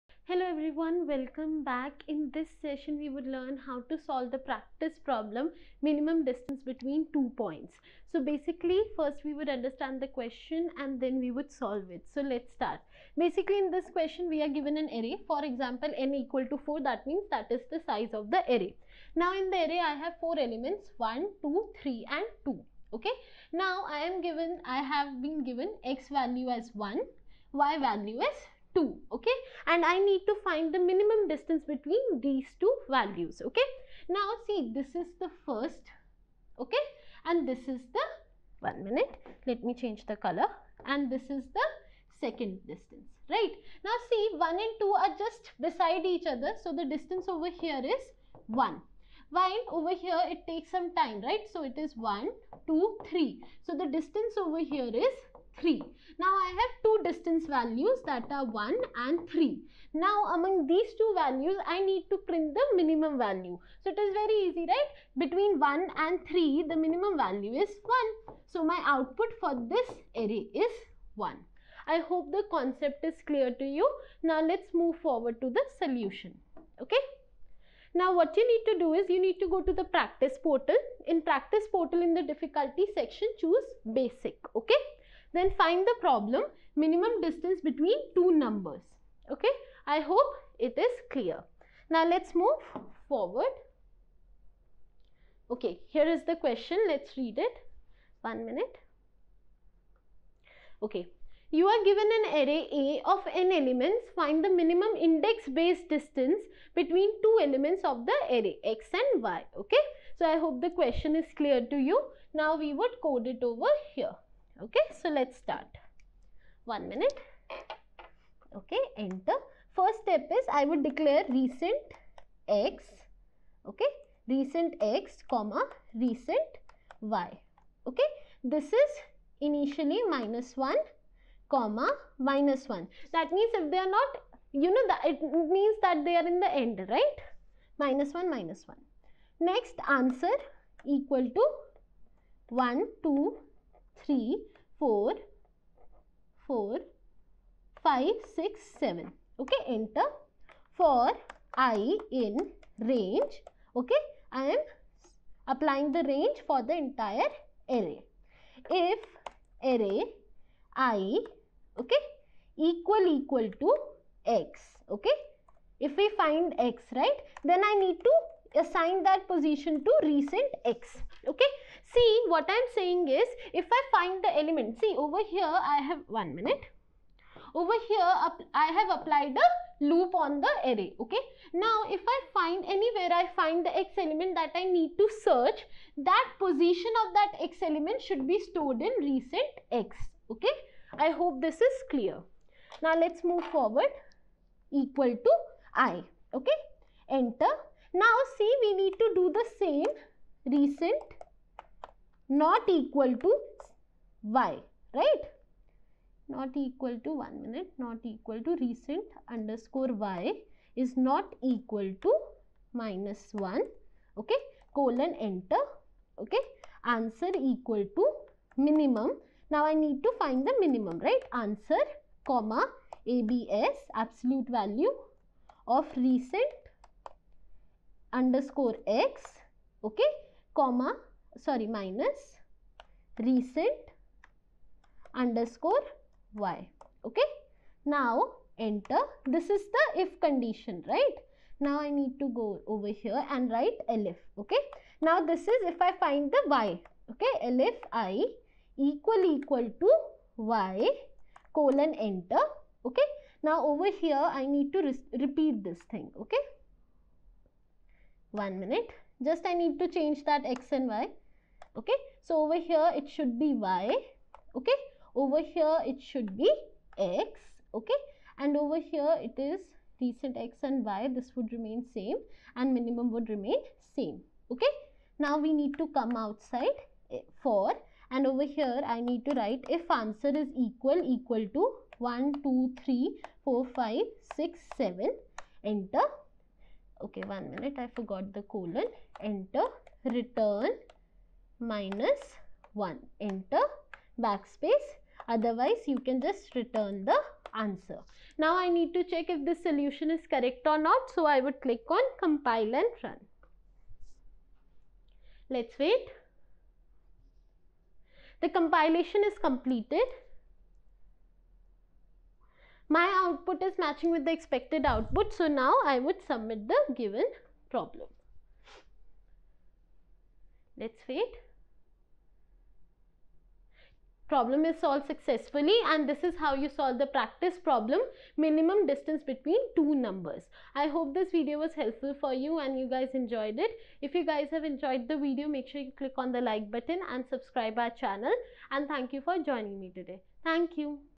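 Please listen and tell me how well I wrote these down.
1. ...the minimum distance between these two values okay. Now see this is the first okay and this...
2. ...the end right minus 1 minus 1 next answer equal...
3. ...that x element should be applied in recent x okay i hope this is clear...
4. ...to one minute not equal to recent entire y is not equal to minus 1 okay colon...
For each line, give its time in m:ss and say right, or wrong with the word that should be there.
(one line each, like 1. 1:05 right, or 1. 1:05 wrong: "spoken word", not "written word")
1. 0:30 right
2. 2:16 right
3. 3:07 wrong: "stored", not "applied"
4. 3:27 wrong: "underscore", not "entire".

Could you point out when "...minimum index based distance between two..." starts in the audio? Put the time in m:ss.
1:44.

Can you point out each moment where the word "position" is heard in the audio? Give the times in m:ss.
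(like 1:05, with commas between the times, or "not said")
2:49, 3:06.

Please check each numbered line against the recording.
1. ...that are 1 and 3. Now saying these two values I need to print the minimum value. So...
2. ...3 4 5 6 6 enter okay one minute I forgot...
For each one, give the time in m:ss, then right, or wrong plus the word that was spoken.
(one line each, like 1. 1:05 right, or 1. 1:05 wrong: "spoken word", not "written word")
1. 0:58 wrong: "among", not "saying"
2. 4:42 wrong: "7", not "6".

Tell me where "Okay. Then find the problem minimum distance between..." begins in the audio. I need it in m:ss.
1:24.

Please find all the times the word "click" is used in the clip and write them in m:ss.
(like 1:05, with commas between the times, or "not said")
5:01, 5:35.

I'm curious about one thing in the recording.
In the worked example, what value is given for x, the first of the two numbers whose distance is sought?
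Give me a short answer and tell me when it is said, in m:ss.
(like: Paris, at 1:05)
1, at 0:25.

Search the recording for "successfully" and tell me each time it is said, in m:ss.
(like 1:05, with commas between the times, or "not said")
5:25.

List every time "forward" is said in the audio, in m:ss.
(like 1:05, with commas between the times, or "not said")
1:14, 1:33, 3:13.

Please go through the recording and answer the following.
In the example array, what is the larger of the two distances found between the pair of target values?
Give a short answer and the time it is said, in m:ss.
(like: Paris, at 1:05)
3, at 0:53.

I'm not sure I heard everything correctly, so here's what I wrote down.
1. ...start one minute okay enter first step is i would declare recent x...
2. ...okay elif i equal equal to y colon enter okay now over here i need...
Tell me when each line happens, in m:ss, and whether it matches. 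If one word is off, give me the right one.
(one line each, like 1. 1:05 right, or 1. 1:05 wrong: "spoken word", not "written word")
1. 1:55 right
2. 4:07 right.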